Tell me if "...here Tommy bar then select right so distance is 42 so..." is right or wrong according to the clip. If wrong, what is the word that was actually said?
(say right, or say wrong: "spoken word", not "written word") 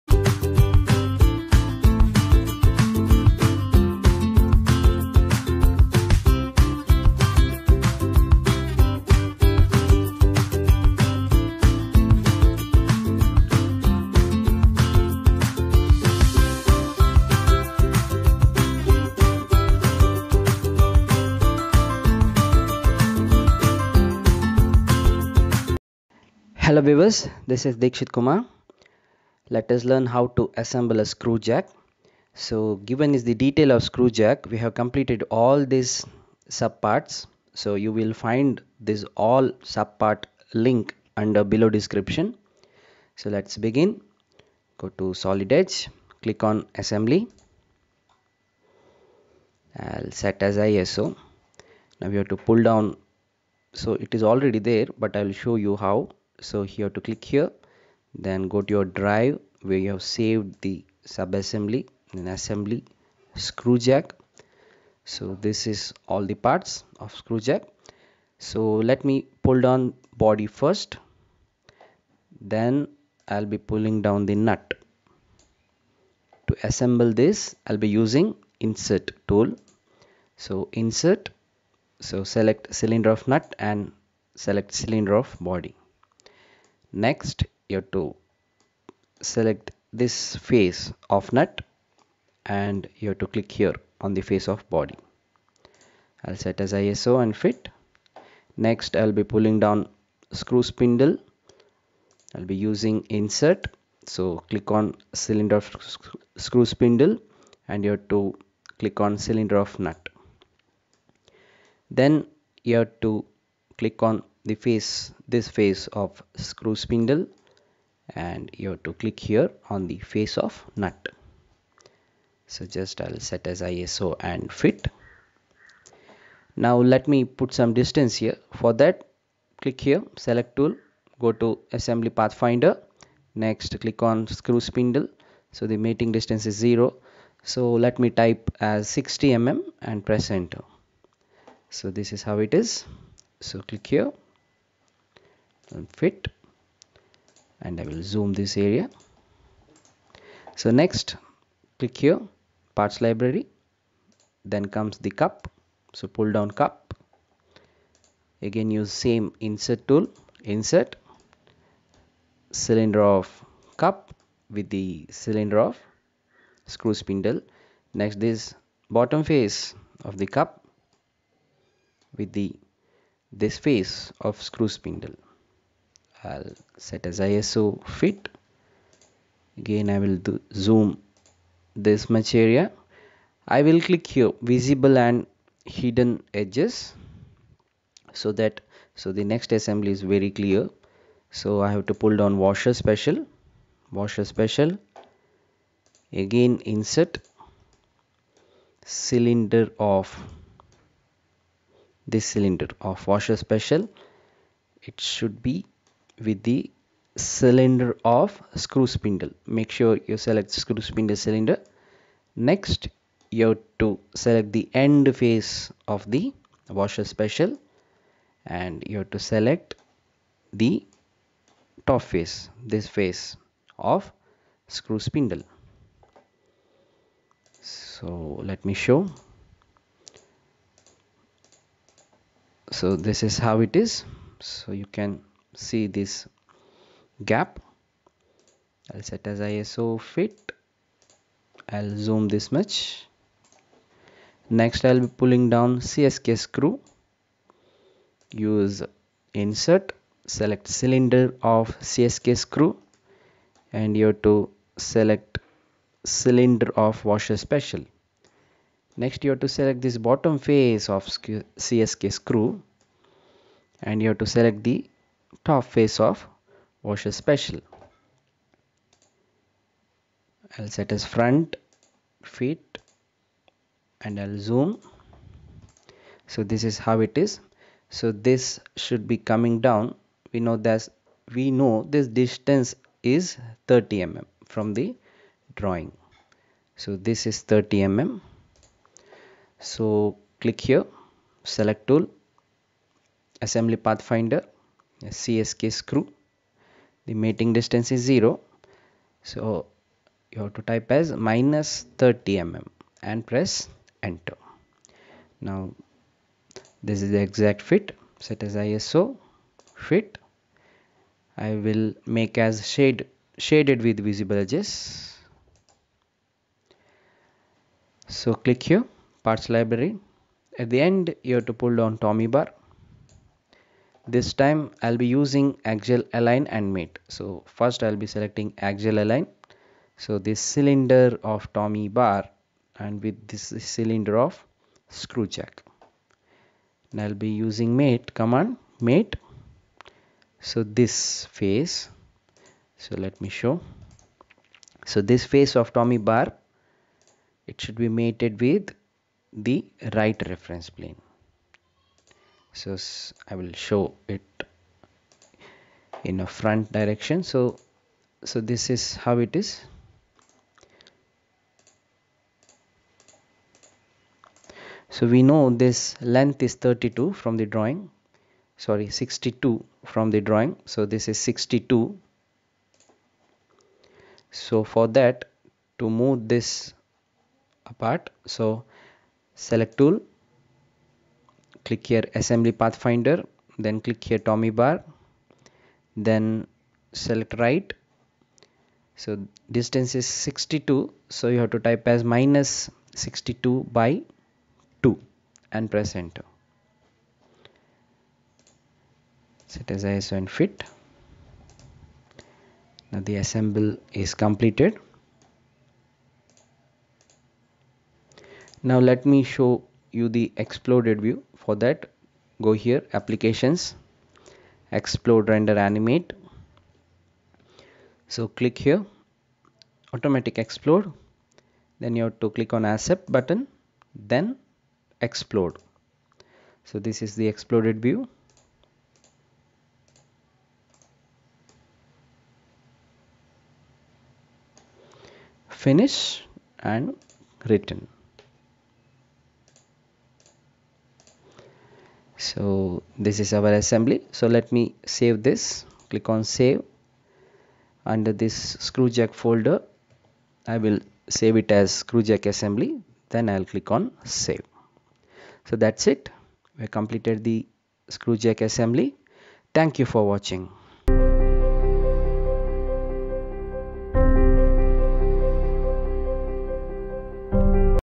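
wrong: "62", not "42".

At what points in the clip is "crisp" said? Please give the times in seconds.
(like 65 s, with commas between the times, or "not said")
not said.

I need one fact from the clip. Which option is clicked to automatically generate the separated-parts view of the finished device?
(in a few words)
automatic explode.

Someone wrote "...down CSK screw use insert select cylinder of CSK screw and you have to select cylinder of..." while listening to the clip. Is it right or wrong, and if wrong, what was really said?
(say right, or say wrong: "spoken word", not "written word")
right.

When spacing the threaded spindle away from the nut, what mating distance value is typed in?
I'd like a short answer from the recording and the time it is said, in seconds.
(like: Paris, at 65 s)
60 mm, at 138 s.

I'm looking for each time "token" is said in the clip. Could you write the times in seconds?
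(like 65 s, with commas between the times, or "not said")
not said.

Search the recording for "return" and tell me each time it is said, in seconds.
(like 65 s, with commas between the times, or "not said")
437 s.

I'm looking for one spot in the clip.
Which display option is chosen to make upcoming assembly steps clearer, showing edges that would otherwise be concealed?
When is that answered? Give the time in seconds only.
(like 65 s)
184 s.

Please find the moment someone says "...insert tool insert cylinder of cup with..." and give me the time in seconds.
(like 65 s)
159 s.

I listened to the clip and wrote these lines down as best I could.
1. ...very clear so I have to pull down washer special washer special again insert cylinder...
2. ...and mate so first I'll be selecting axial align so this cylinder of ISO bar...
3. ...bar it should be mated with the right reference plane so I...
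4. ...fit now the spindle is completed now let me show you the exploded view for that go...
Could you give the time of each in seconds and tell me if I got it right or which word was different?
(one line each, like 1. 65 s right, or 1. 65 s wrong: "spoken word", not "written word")
1. 190 s right
2. 326 s wrong: "Tommy", not "ISO"
3. 345 s right
4. 400 s wrong: "assemble", not "spindle".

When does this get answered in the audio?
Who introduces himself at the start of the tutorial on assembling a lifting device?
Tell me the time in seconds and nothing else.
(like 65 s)
27 s.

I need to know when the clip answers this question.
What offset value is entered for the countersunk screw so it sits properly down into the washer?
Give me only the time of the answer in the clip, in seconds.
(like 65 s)
301 s.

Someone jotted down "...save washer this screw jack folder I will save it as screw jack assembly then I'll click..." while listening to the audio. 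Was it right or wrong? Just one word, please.
wrong.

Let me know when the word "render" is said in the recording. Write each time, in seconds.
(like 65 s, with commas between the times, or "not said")
415 s.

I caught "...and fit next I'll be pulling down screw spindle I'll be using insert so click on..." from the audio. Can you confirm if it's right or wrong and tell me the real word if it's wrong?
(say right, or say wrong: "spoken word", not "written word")
right.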